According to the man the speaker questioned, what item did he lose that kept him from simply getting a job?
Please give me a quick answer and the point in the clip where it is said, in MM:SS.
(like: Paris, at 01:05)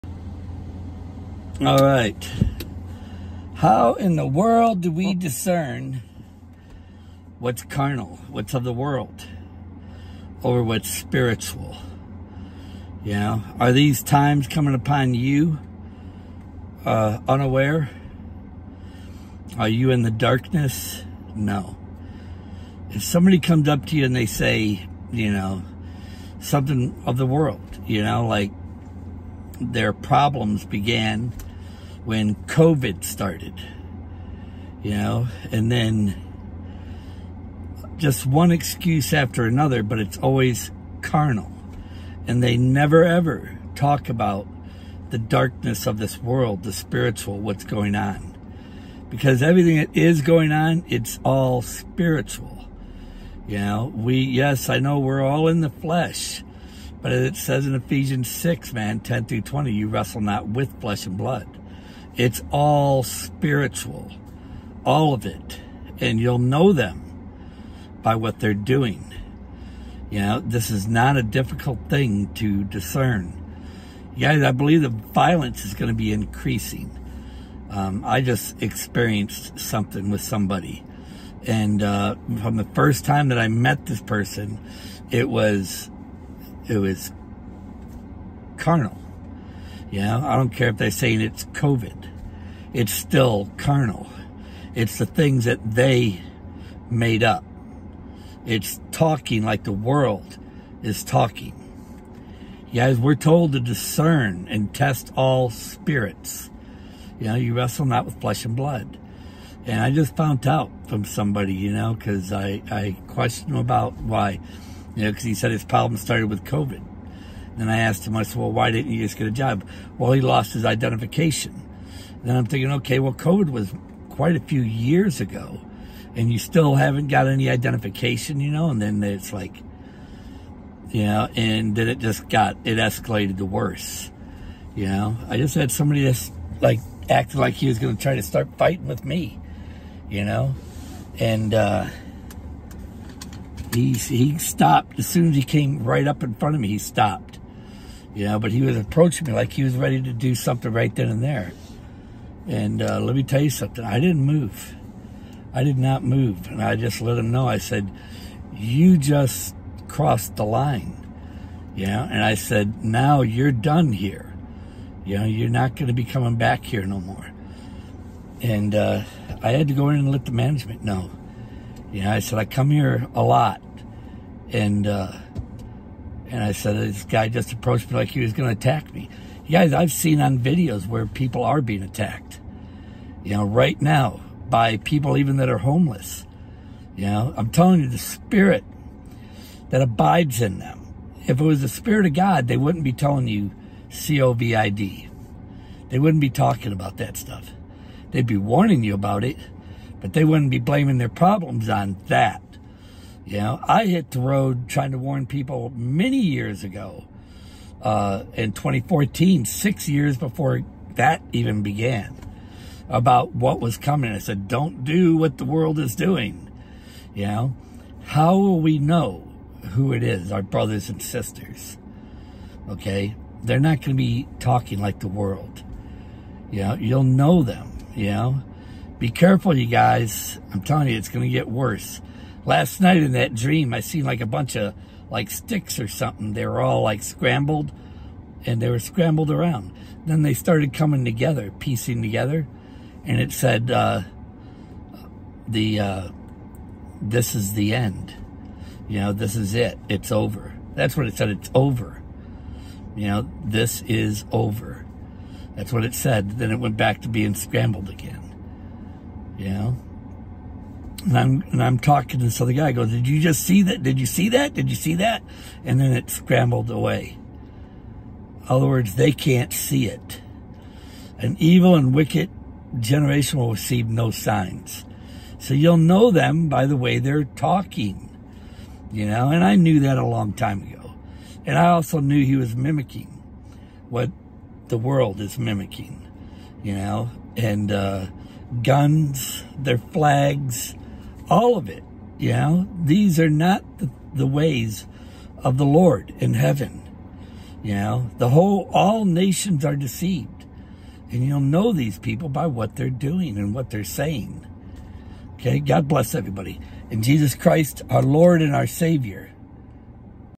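His identification, at 02:00.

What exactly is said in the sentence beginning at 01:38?
It's talking like the world is talking.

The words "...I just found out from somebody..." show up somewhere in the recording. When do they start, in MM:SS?
01:49.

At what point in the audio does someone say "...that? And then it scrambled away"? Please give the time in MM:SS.
04:24.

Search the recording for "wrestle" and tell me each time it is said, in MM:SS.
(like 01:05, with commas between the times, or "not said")
00:59, 01:47.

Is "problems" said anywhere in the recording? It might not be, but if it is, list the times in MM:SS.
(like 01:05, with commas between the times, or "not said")
00:29, 01:55, 03:21.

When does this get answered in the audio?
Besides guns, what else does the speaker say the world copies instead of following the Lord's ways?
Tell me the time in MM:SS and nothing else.
04:49.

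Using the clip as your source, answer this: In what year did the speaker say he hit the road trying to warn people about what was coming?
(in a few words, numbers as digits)
2014.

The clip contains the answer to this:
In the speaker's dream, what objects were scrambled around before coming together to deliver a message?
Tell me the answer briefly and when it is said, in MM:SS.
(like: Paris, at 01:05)
Sticks, at 03:55.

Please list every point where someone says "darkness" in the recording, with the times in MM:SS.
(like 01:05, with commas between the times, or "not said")
00:20, 00:45.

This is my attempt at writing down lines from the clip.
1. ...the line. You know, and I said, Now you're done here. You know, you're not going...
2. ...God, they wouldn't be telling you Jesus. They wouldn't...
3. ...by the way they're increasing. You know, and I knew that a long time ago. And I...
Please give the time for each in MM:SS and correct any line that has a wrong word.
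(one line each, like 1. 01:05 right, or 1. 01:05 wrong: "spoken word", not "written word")
1. 02:40 right
2. 03:12 wrong: "COVID", not "Jesus"
3. 04:36 wrong: "talking", not "increasing".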